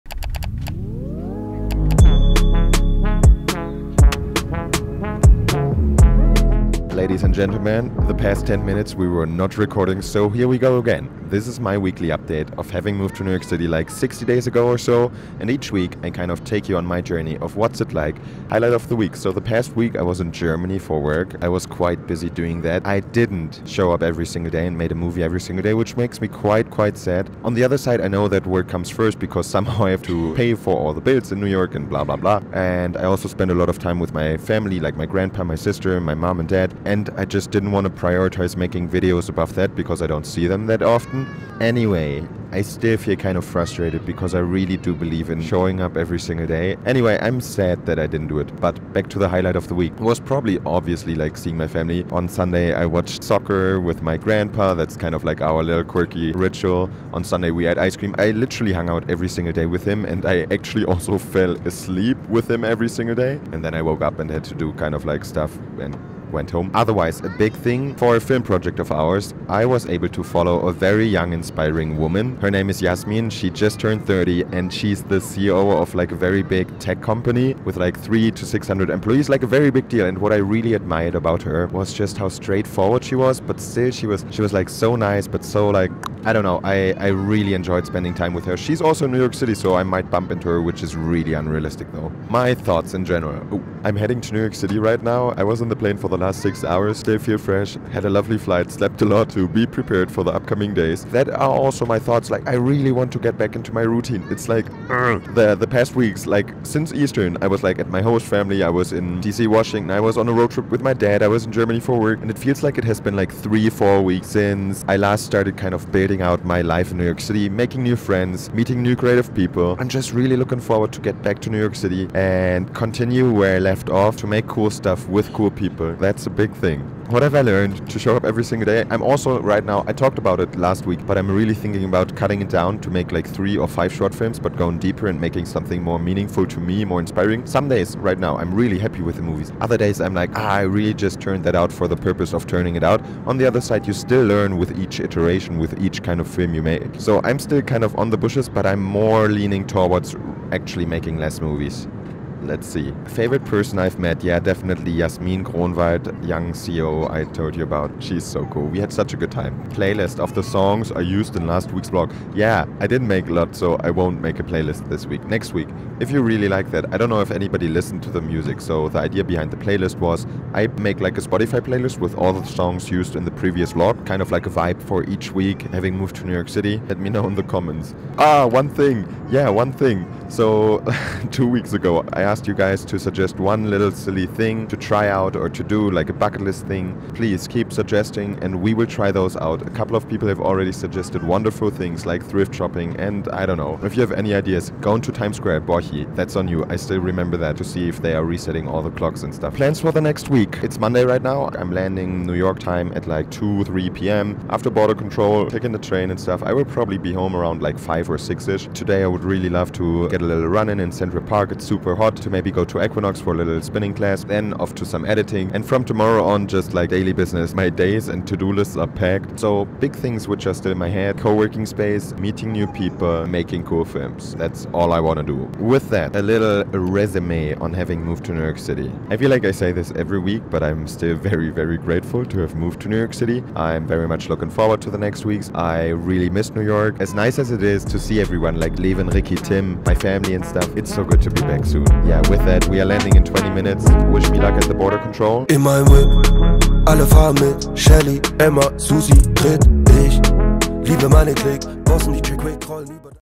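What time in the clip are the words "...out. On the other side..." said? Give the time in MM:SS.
02:22.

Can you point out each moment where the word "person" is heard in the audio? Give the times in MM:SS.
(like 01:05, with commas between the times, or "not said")
02:33.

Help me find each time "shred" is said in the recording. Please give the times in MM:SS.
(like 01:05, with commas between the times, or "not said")
not said.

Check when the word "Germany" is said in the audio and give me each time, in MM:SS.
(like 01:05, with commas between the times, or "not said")
00:20, 01:51.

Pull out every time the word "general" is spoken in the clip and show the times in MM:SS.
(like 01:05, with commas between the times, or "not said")
01:33.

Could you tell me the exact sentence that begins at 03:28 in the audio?
Today, I would really love to get get a little run in in Central Park.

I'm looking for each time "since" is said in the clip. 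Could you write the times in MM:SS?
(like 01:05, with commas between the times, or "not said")
01:46, 01:54.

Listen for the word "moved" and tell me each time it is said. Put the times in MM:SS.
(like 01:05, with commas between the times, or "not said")
00:12, 02:55, 03:48, 03:52.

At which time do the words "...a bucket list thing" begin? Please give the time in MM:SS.
03:06.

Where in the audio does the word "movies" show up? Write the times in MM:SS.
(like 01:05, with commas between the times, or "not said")
00:24, 02:19, 02:31.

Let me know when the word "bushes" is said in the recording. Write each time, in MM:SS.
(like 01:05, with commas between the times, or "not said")
02:28.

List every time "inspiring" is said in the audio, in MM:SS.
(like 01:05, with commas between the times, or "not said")
01:11, 02:16.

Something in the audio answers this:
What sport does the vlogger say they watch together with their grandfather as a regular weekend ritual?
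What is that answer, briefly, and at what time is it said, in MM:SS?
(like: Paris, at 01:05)
Soccer, at 00:53.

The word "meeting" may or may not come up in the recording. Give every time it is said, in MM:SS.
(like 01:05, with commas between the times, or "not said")
01:58, 03:42.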